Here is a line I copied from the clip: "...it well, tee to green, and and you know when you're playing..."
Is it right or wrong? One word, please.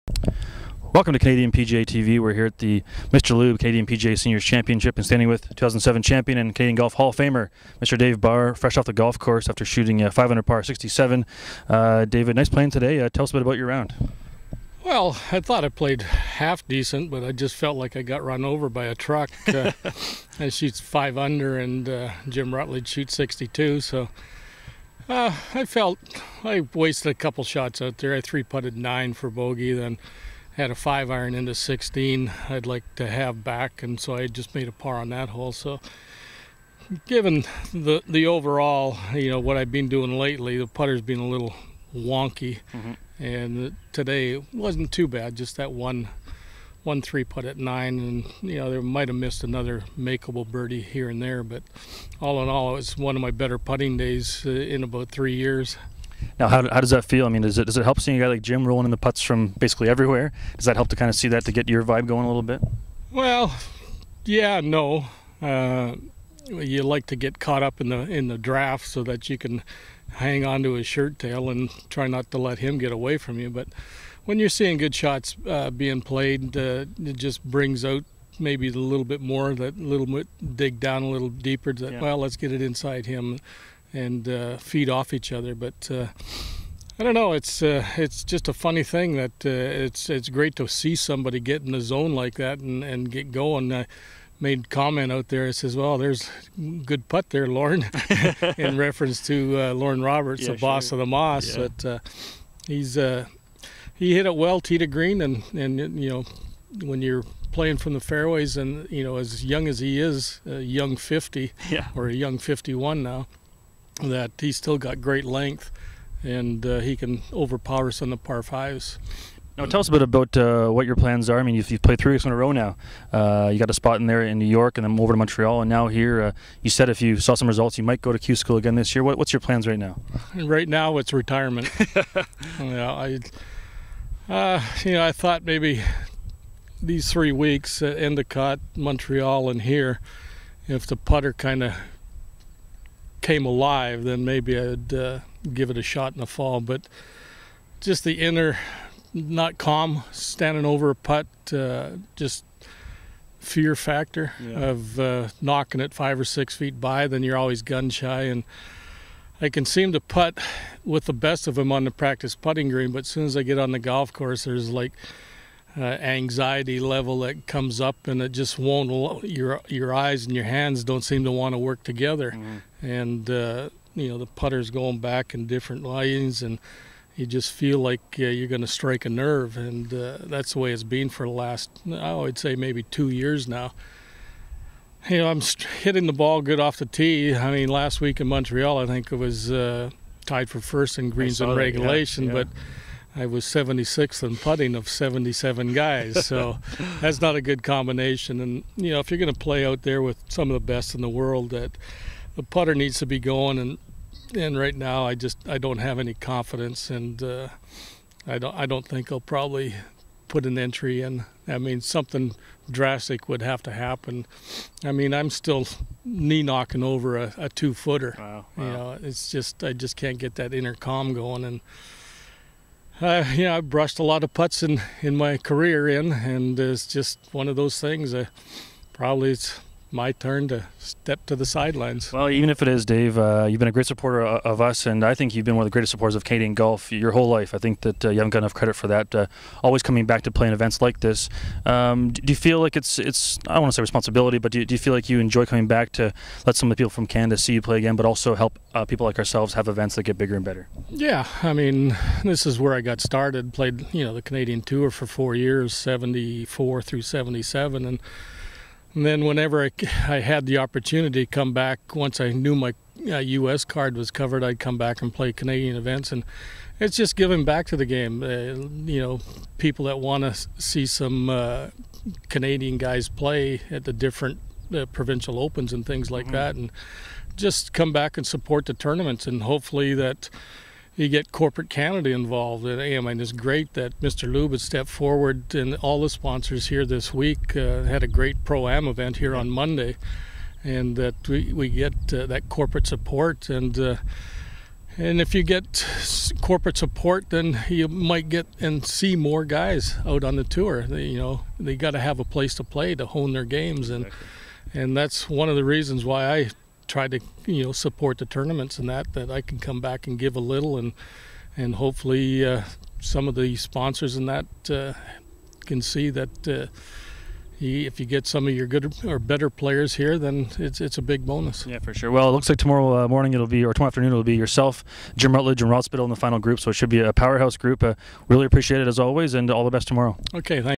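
right.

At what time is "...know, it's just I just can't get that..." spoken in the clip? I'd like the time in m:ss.
3:38.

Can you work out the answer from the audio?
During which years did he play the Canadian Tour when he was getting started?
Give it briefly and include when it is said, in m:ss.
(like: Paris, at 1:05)
1974 through 1977, at 4:15.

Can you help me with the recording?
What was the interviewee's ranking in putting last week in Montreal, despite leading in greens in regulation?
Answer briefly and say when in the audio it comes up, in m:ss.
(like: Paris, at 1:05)
76th, at 3:13.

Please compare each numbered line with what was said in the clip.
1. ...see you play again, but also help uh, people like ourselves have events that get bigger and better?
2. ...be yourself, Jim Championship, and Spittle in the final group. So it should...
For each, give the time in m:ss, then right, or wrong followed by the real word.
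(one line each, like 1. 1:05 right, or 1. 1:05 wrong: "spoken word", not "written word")
1. 4:07 right
2. 5:24 wrong: "Rutledge", not "Championship".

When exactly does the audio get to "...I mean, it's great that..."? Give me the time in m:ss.
4:42.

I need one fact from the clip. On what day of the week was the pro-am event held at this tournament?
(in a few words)
Monday.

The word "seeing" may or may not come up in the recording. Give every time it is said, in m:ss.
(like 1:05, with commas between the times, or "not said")
0:57, 1:14.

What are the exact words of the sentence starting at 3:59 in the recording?
Uh, always coming back to playing events like this.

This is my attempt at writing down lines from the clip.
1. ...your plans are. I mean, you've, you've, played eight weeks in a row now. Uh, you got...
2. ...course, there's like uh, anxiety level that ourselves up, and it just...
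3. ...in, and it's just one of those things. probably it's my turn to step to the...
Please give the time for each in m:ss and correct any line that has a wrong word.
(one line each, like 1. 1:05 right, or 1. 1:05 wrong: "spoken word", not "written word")
1. 2:00 wrong: "three", not "eight"
2. 2:44 wrong: "comes", not "ourselves"
3. 3:45 right.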